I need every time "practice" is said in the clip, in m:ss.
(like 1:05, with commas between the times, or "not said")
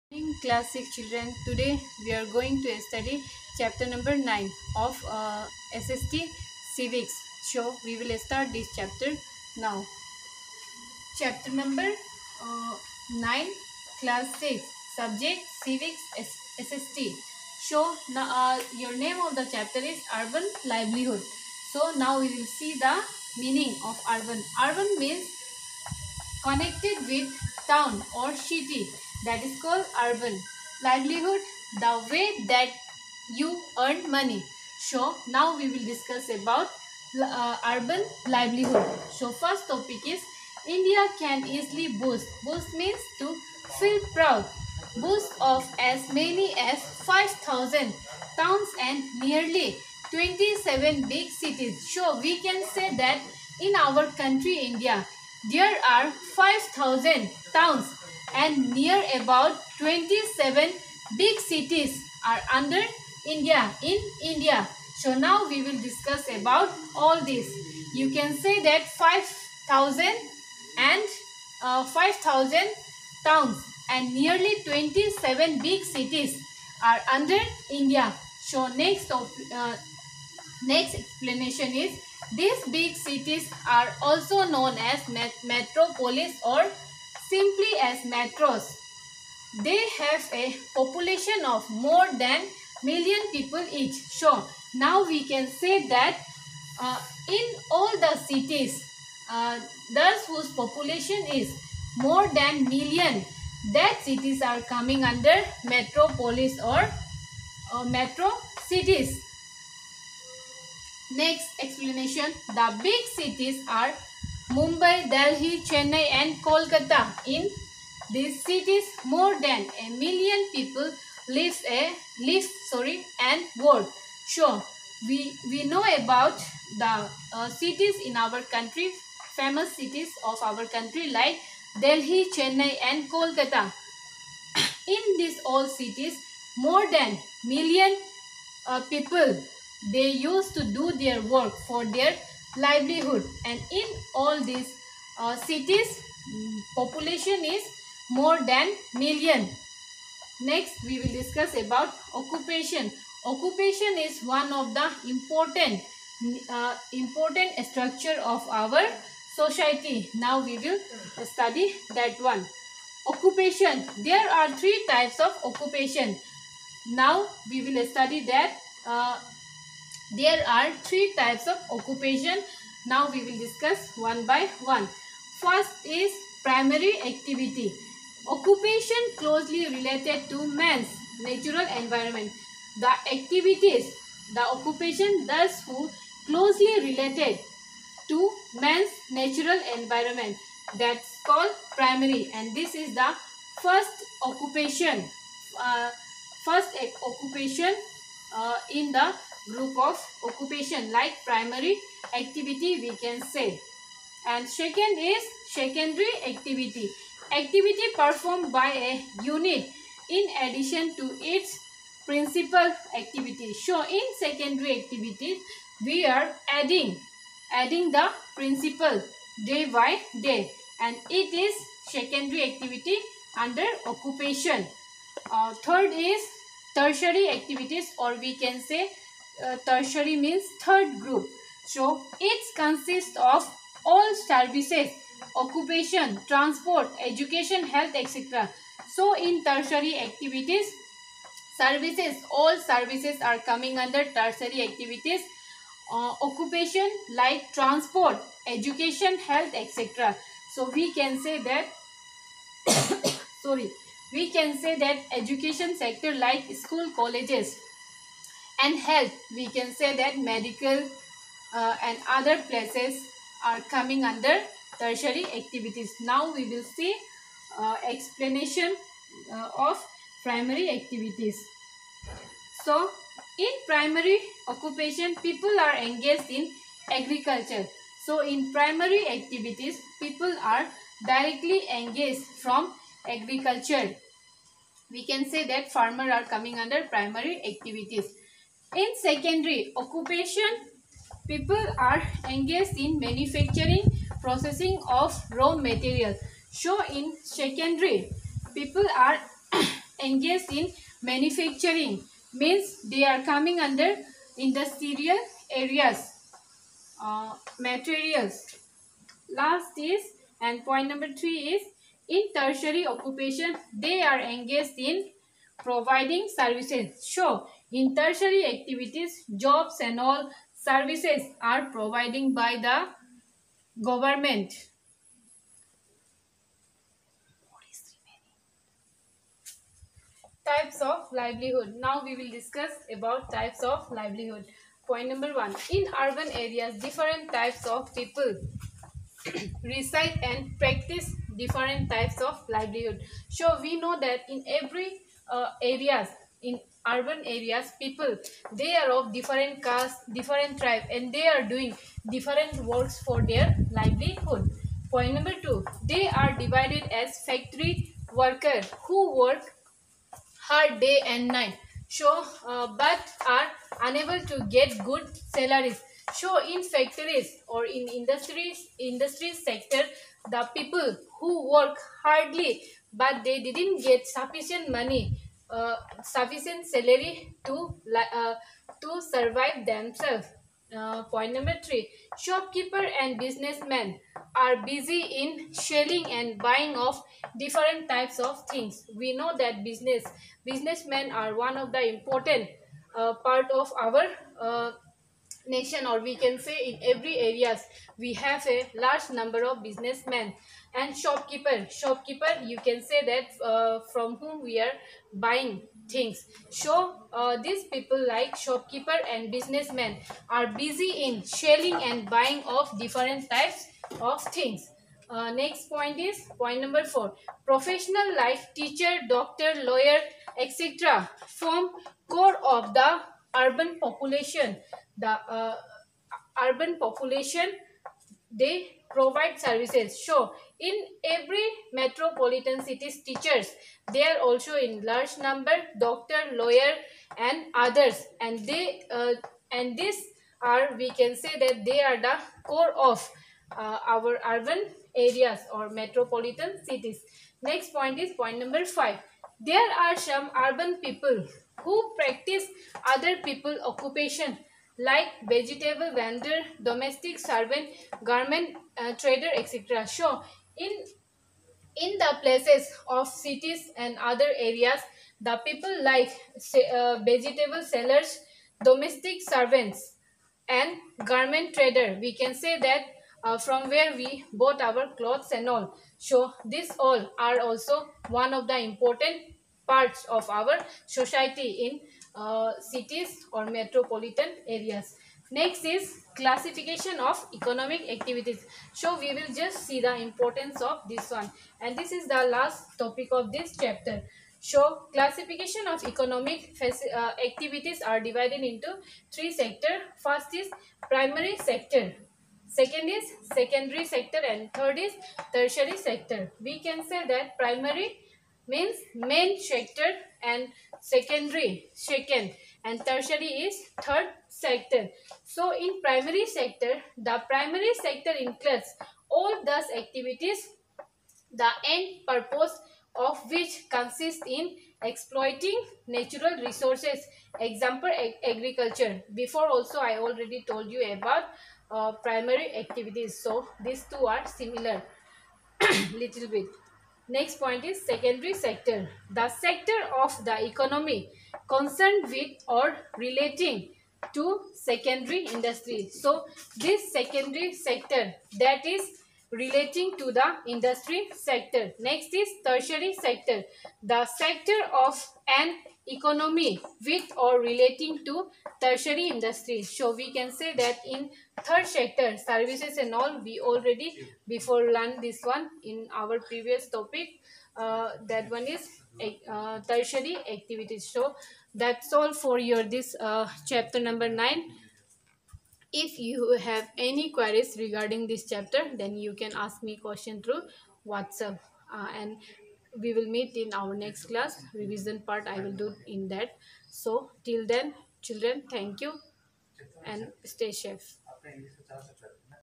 5:40, 7:31.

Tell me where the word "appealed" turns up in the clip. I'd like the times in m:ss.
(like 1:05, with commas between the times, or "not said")
not said.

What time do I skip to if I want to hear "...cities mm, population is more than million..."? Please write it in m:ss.
2:25.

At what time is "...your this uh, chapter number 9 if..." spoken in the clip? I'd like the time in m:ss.
9:32.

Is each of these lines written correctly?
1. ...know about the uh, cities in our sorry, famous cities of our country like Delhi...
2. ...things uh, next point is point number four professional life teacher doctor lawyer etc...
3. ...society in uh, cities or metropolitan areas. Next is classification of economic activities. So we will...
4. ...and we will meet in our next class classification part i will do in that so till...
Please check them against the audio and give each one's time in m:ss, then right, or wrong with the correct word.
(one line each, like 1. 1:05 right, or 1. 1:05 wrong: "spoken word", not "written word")
1. 2:05 wrong: "country", not "sorry"
2. 6:54 right
3. 8:00 right
4. 9:41 wrong: "revision", not "classification".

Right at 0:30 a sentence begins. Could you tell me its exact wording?
Livelihood, the way that you earn money.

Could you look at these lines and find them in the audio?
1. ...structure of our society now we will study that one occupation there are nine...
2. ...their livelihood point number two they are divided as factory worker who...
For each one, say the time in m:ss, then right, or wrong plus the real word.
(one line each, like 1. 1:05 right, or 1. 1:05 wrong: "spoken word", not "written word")
1. 2:37 wrong: "three", not "nine"
2. 5:53 right.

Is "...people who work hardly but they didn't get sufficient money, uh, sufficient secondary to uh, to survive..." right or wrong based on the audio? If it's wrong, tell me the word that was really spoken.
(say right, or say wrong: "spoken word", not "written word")
wrong: "salary", not "secondary".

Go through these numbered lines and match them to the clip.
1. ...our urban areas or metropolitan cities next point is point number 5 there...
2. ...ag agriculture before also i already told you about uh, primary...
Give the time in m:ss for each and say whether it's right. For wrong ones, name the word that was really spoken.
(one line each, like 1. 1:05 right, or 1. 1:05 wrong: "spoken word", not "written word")
1. 7:23 right
2. 8:47 right.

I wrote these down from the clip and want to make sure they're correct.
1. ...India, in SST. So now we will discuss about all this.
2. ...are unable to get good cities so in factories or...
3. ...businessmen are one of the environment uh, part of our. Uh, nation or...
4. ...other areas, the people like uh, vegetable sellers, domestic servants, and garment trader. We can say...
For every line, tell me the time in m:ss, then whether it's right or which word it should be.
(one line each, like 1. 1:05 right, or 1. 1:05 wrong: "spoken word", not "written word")
1. 1:03 wrong: "India", not "SST"
2. 6:03 wrong: "salaries", not "cities"
3. 6:30 wrong: "important", not "environment"
4. 7:43 right.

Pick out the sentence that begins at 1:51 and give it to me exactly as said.
Next explanation, the big cities are Mumbai, Delhi, Chennai and Kolkata.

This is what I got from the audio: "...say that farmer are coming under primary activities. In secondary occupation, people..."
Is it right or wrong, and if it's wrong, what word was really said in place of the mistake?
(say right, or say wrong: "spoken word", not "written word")
right.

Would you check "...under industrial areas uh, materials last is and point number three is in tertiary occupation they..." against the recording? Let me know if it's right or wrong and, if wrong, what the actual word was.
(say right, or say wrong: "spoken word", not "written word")
right.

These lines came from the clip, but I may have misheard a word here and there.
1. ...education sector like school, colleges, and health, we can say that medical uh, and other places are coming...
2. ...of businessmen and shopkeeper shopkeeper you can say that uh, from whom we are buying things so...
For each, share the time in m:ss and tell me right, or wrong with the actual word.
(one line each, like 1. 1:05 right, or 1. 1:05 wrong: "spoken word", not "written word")
1. 4:15 right
2. 6:39 right.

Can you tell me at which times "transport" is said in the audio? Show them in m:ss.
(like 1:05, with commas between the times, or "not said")
3:56, 4:07.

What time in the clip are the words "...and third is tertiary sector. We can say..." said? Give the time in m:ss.
8:24.